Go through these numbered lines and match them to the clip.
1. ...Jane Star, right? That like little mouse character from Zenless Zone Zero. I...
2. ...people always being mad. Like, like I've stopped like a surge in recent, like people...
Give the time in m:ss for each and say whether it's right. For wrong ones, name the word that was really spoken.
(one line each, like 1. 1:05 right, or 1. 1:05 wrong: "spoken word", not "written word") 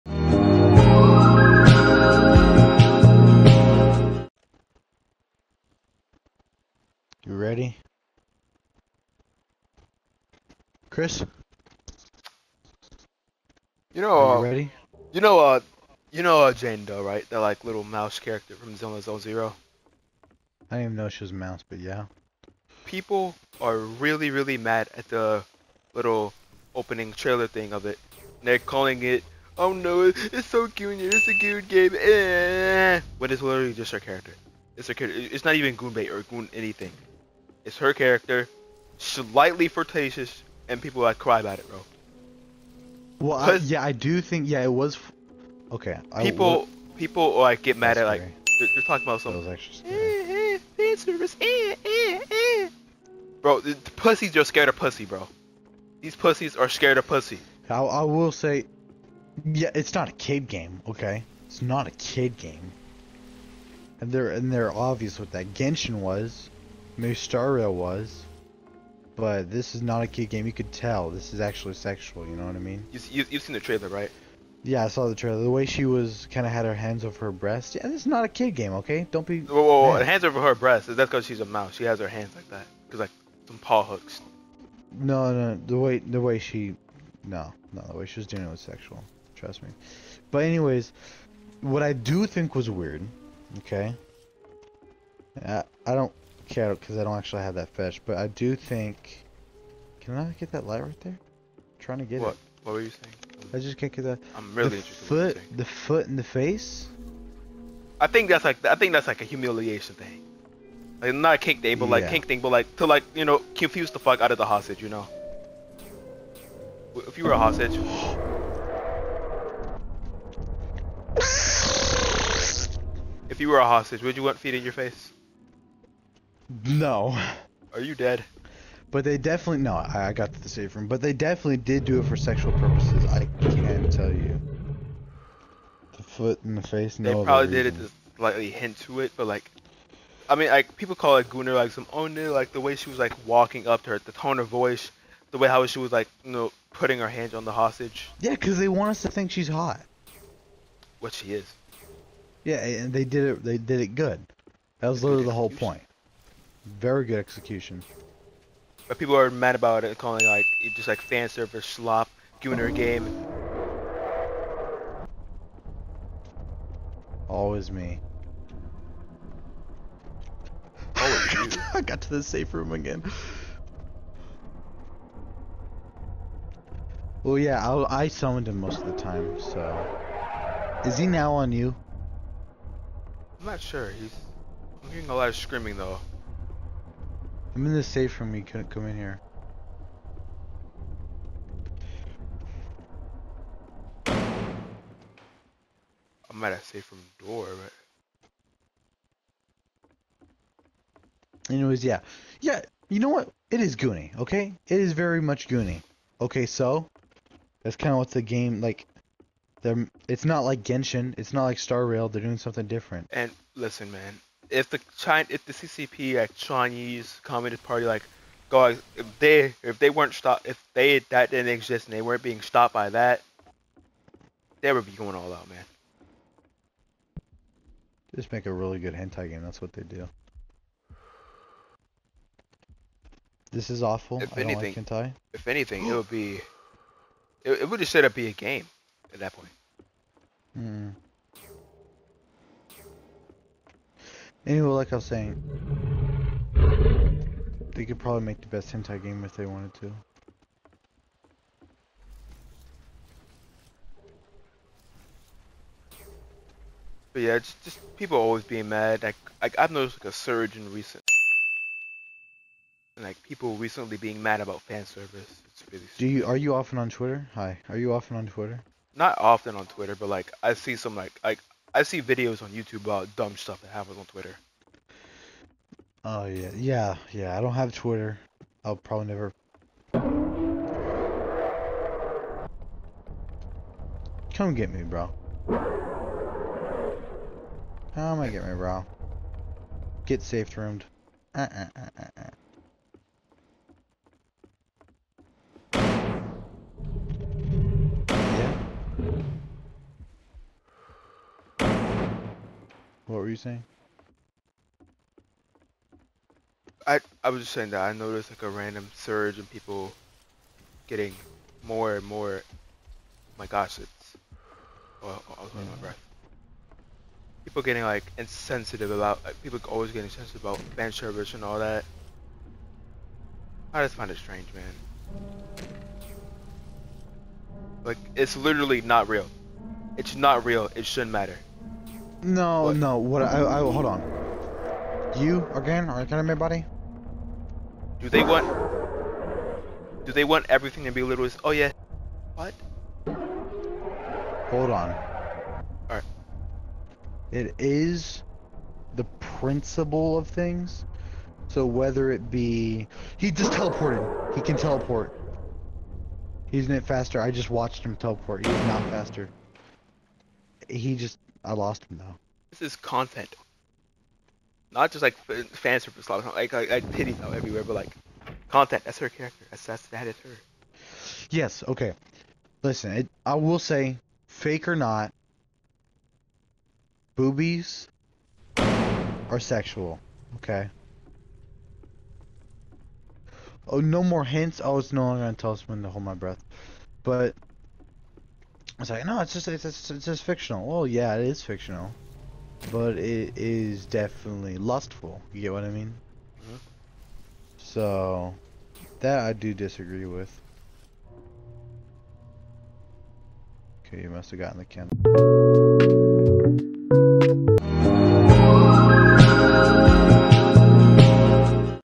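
1. 0:16 wrong: "Doe", not "Star"
2. 4:17 wrong: "noticed", not "stopped".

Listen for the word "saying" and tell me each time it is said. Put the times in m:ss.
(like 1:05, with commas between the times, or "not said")
1:42, 4:05, 5:03, 5:07.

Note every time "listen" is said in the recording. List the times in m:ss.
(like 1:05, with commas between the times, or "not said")
3:33, 6:12.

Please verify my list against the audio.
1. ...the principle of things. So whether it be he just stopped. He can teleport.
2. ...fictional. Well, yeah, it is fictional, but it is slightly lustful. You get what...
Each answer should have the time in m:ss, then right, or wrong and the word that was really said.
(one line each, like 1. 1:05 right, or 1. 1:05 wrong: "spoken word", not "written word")
1. 5:48 wrong: "teleported", not "stopped"
2. 6:30 wrong: "definitely", not "slightly".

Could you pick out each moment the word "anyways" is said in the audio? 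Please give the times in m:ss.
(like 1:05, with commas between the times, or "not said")
1:30, 3:21, 4:04.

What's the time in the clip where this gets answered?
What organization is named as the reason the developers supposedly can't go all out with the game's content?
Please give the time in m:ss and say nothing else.
3:36.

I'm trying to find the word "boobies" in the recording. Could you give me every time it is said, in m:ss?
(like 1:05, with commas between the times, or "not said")
6:17.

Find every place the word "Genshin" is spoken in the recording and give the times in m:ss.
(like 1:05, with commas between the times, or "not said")
1:05, 3:30.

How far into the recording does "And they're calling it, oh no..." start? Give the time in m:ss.
0:28.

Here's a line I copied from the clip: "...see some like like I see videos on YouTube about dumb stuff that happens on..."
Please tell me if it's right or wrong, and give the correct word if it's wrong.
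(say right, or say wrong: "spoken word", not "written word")
right.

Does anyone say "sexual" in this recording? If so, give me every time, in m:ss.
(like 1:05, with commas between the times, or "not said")
1:11, 1:28, 2:12, 6:19.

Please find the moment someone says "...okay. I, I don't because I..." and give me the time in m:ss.
1:33.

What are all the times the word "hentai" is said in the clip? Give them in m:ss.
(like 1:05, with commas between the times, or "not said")
3:48, 3:54, 4:08.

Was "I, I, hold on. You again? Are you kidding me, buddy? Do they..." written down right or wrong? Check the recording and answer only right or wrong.
right.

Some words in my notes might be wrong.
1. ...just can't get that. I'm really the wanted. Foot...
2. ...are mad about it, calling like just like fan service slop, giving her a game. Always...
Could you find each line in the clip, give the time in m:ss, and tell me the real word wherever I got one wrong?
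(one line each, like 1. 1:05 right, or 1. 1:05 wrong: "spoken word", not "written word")
1. 1:43 wrong: "interested", not "wanted"
2. 2:39 right.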